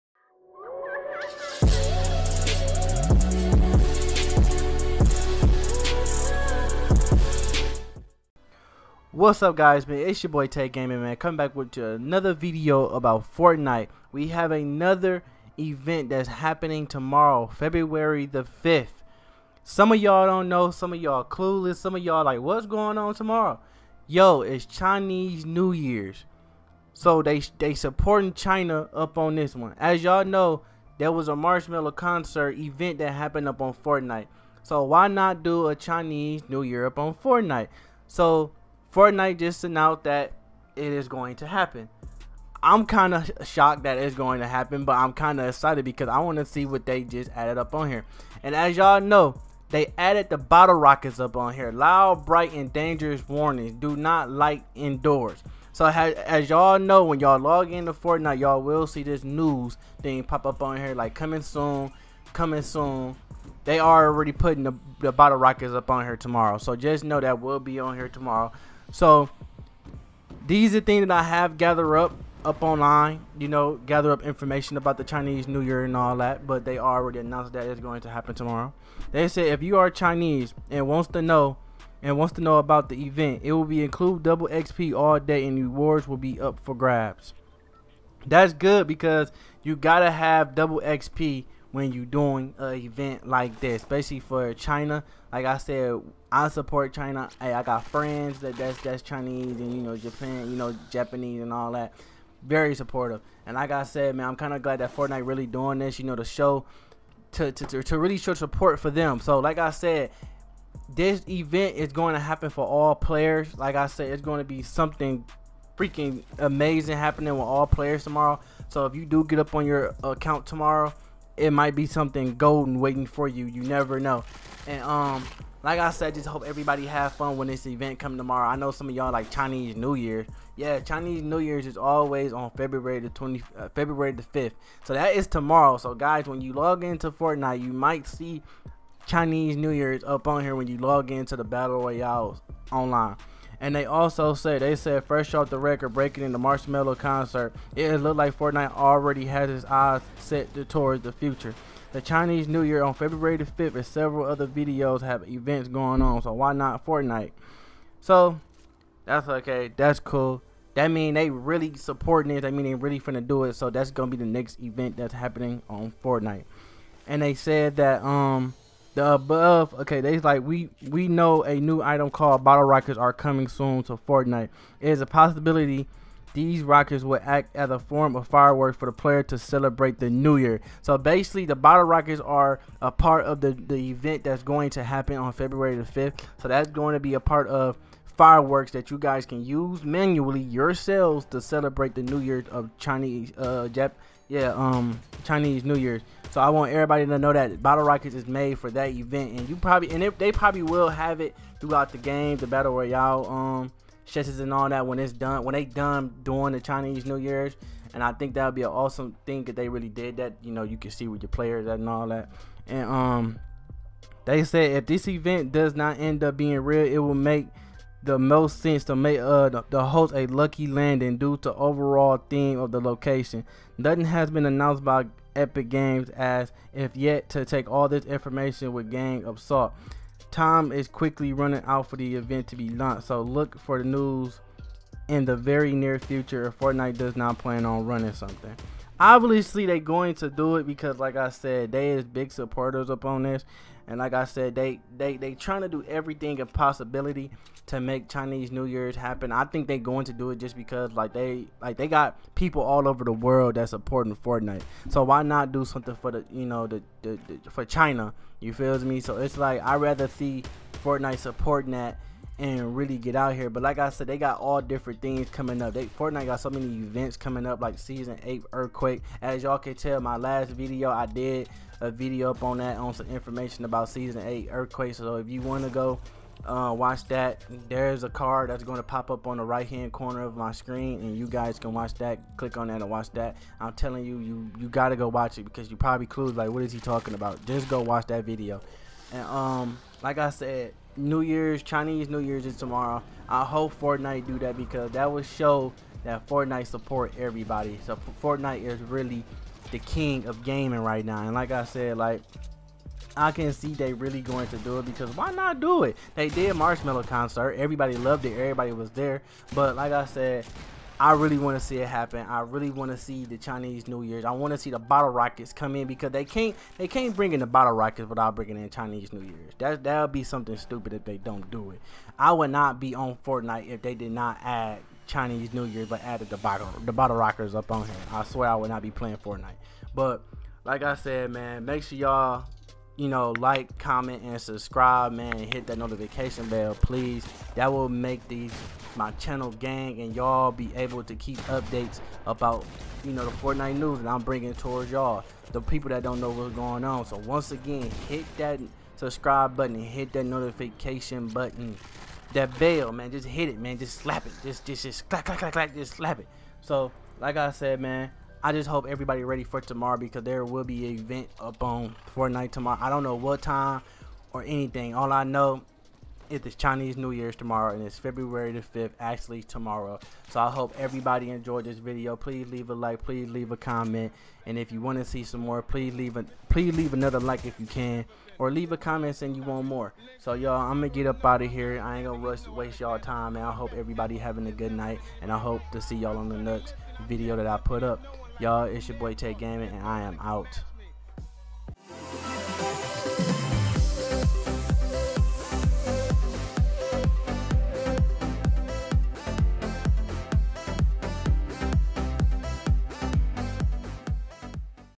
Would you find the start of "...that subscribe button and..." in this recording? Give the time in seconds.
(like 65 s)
348 s.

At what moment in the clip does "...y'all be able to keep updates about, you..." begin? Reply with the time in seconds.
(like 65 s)
340 s.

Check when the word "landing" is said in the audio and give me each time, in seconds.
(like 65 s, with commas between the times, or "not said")
220 s.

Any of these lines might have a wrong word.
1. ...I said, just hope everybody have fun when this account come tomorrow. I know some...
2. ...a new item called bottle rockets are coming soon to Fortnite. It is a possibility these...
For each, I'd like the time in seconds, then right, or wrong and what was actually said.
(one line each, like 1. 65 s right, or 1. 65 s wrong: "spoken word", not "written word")
1. 125 s wrong: "event", not "account"
2. 171 s right.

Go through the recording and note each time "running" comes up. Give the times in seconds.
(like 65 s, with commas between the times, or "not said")
231 s, 237 s.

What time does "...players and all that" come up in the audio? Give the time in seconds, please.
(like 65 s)
211 s.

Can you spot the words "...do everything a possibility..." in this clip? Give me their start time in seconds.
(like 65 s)
245 s.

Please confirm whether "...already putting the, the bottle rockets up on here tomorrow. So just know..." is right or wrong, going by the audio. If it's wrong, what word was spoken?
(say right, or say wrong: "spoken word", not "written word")
right.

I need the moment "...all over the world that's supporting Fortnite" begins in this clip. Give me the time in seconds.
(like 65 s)
252 s.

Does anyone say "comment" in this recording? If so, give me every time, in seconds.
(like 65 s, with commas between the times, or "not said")
333 s, 373 s, 378 s.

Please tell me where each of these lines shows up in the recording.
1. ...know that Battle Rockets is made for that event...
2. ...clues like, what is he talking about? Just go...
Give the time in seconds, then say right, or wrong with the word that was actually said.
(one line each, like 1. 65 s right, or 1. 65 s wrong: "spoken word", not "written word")
1. 197 s right
2. 286 s right.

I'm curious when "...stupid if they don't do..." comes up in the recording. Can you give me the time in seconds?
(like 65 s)
320 s.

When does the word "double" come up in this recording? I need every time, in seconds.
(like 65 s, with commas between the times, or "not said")
84 s, 90 s.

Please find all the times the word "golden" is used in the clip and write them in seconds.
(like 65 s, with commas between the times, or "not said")
122 s.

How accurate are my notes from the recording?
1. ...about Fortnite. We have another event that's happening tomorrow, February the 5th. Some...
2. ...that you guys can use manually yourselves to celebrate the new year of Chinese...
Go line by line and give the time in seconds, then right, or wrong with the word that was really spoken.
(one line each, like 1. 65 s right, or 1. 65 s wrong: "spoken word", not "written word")
1. 12 s right
2. 188 s right.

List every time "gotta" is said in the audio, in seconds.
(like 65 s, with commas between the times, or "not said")
89 s, 284 s.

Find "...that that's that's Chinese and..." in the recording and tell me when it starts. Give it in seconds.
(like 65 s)
98 s.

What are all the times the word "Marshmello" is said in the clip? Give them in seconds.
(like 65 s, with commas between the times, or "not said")
31 s, 146 s, 306 s.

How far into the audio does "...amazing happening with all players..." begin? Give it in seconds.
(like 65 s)
116 s.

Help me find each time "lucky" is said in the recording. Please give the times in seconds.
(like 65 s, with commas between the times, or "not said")
220 s.